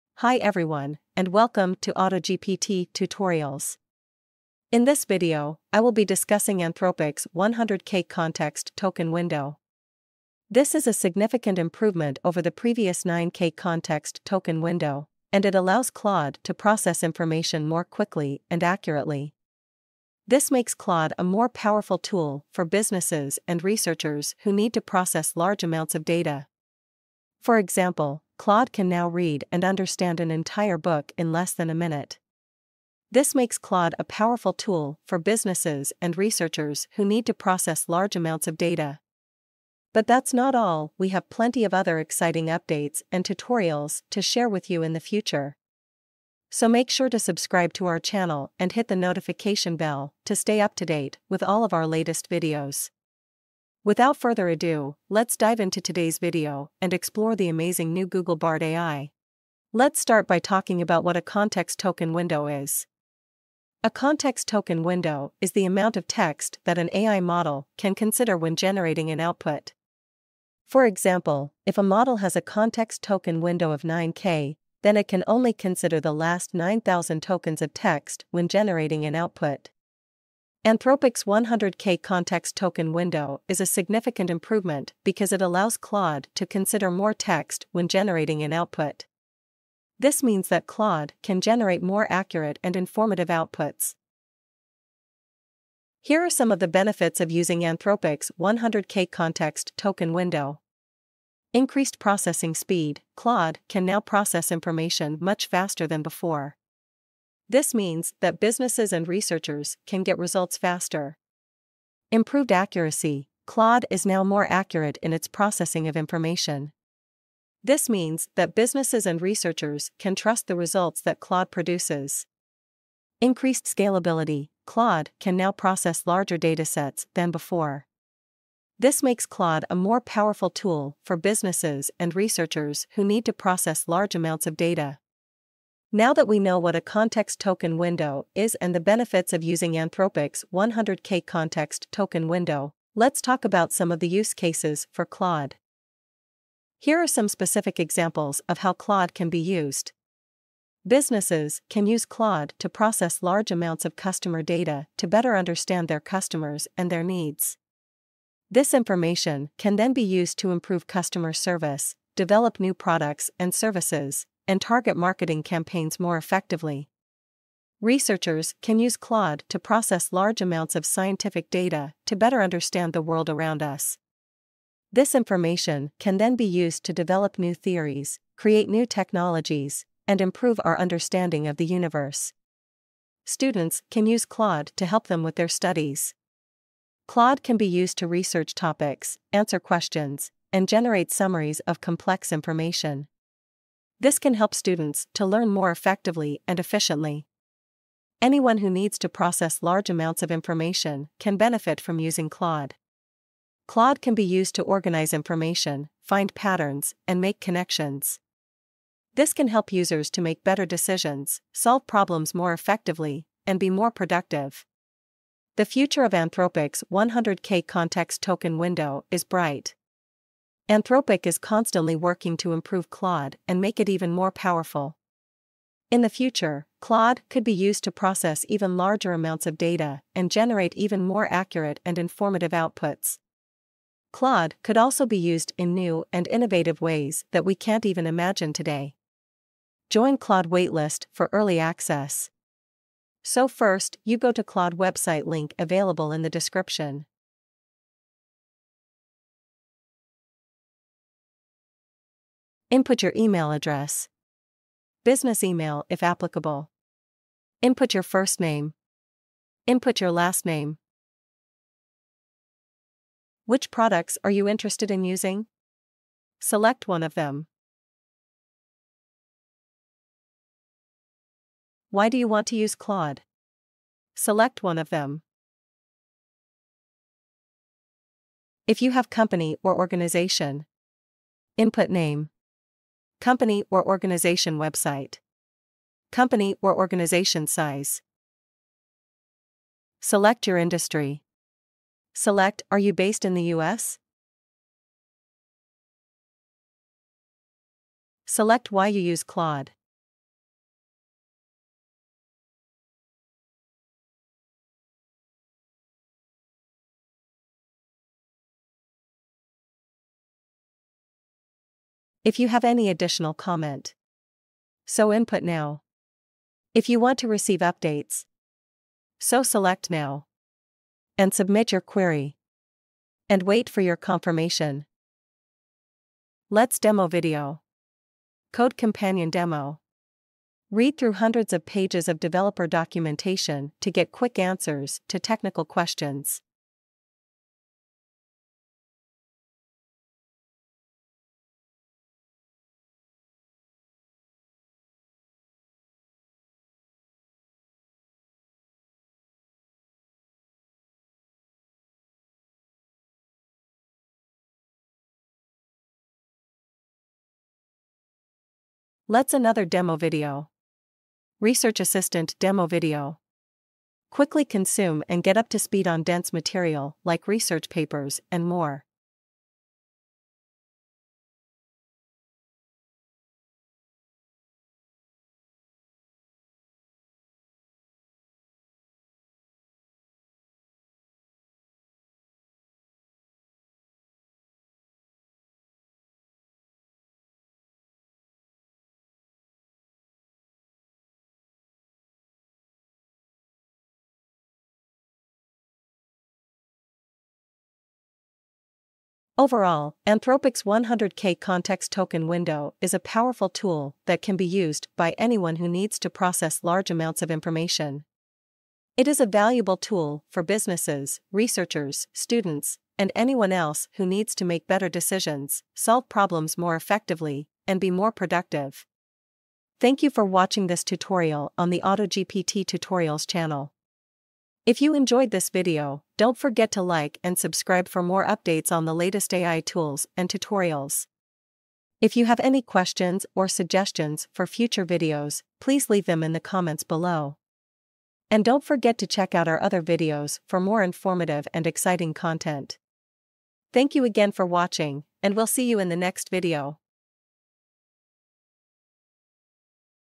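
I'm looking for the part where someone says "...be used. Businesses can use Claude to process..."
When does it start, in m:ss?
2:29.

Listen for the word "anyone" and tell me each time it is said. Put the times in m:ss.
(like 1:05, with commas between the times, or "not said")
3:18, 6:45, 6:53.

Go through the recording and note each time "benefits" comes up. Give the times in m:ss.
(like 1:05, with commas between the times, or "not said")
1:36, 2:18, 3:21.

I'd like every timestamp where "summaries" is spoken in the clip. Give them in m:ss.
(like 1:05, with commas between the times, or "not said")
3:11.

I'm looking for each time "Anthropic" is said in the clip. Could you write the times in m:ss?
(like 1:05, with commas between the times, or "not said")
0:06, 1:20, 1:37, 2:19, 3:36, 3:40, 6:40.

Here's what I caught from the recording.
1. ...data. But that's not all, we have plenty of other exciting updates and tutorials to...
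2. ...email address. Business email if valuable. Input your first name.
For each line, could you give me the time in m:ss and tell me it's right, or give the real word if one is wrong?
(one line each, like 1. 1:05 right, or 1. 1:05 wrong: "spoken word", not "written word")
1. 0:38 right
2. 4:13 wrong: "applicable", not "valuable".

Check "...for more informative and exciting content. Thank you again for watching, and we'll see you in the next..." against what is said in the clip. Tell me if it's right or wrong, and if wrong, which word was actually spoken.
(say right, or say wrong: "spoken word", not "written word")
right.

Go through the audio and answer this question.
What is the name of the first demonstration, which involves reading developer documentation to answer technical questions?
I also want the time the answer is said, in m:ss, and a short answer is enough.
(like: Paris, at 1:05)
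Code Companion, at 5:28.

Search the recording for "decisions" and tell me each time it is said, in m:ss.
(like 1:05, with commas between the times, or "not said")
3:30, 6:54.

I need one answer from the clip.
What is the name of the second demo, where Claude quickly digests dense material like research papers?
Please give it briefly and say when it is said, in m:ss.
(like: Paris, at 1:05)
Research Assistant, at 6:01.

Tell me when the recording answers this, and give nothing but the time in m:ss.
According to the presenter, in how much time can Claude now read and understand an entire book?
0:31.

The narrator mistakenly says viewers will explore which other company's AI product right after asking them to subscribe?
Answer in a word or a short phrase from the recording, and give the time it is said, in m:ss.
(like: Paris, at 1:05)
Google Bard, at 0:58.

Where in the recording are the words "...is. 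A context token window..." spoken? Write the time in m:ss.
1:02.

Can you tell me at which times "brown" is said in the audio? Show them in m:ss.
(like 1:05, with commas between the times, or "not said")
not said.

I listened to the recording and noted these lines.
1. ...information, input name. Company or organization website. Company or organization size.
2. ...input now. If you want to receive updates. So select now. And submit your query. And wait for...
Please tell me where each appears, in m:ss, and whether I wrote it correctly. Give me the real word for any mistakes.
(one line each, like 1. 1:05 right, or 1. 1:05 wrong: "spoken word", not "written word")
1. 4:39 wrong: "organization", not "information"
2. 5:15 right.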